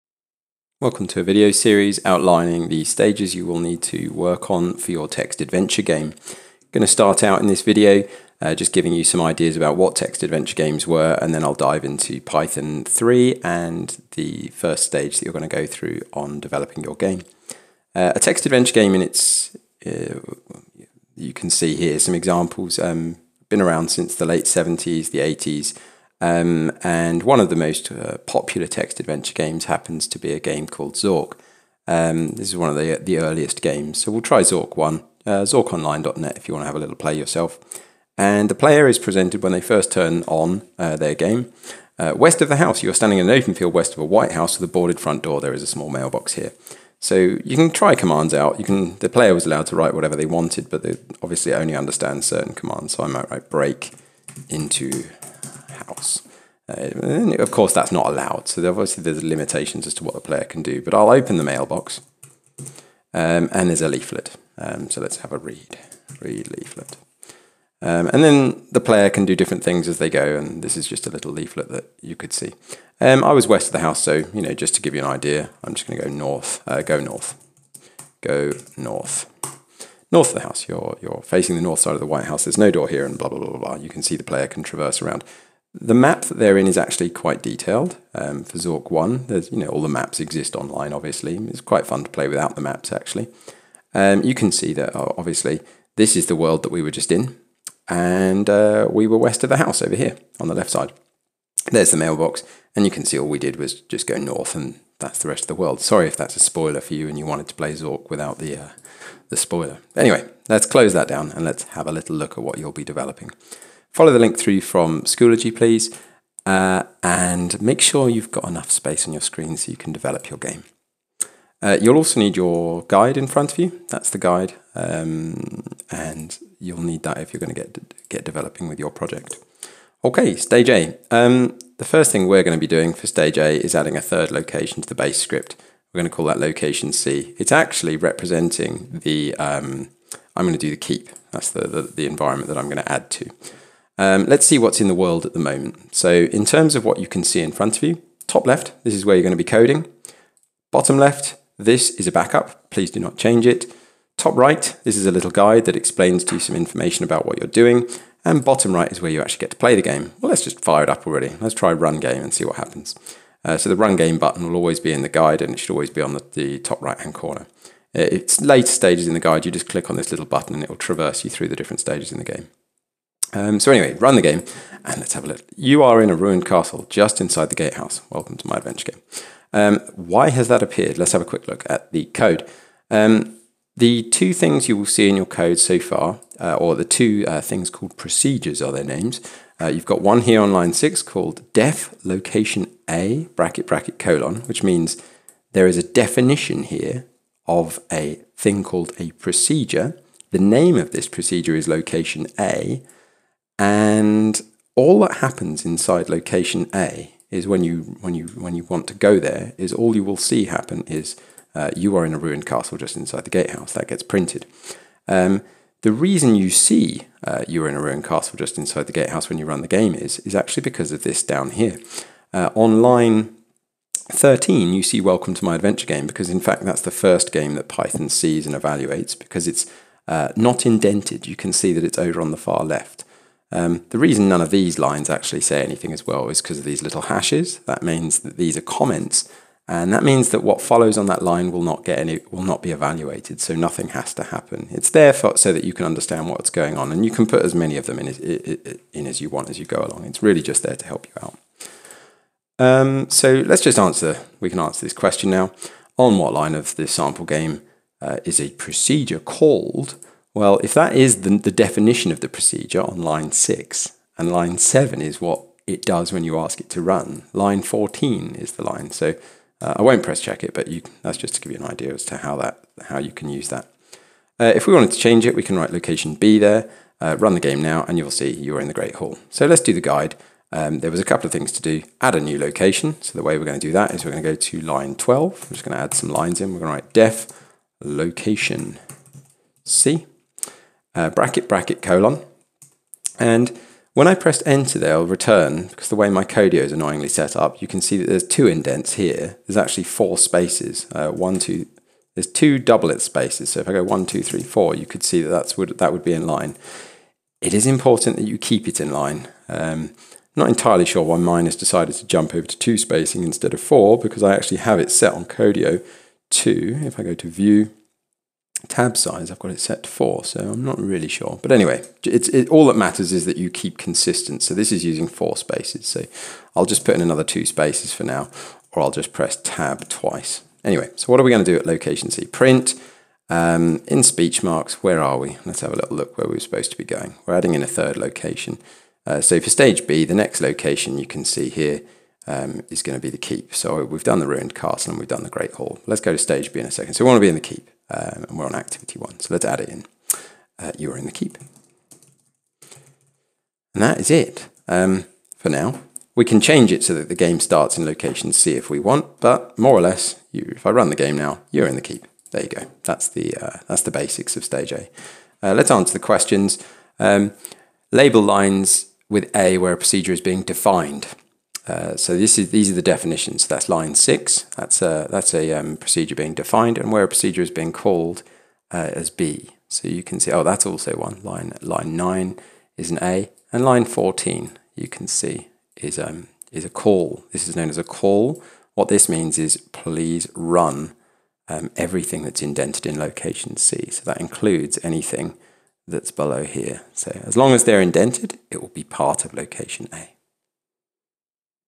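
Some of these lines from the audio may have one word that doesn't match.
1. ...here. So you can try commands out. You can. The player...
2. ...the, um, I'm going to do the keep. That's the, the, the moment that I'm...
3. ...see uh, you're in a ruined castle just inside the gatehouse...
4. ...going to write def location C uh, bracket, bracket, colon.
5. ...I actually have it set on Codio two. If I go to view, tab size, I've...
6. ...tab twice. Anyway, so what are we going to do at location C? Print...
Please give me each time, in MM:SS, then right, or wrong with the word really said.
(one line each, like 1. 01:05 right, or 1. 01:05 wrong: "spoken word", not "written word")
1. 00:46 right
2. 02:19 wrong: "environment", not "moment"
3. 03:36 right
4. 04:46 right
5. 05:14 right
6. 05:29 right.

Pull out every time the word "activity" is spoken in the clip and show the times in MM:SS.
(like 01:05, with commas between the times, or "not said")
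05:48.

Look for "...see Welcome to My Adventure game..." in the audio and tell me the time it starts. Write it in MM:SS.
03:44.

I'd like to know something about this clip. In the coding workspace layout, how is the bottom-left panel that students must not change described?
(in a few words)
a backup.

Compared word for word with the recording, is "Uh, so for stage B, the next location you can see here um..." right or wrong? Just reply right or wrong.
right.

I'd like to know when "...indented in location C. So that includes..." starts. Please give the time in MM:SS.
06:32.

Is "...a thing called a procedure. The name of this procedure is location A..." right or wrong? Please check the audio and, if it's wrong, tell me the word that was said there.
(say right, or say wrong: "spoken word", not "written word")
right.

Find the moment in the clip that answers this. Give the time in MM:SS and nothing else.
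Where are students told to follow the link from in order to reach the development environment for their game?
01:55.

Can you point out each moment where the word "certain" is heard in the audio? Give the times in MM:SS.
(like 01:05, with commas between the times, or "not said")
00:52.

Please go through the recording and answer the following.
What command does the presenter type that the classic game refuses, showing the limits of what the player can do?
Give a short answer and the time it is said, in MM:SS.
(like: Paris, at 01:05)
break into house, at 00:53.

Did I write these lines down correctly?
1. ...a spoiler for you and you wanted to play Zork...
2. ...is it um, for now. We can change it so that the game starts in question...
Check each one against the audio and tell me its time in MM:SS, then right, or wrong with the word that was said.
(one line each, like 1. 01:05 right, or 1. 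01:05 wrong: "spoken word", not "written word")
1. 01:46 right
2. 05:53 wrong: "location", not "question".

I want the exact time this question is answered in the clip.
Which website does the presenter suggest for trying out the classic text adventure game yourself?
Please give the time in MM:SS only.
00:35.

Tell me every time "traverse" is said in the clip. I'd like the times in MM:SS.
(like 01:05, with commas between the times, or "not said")
01:24, 02:50.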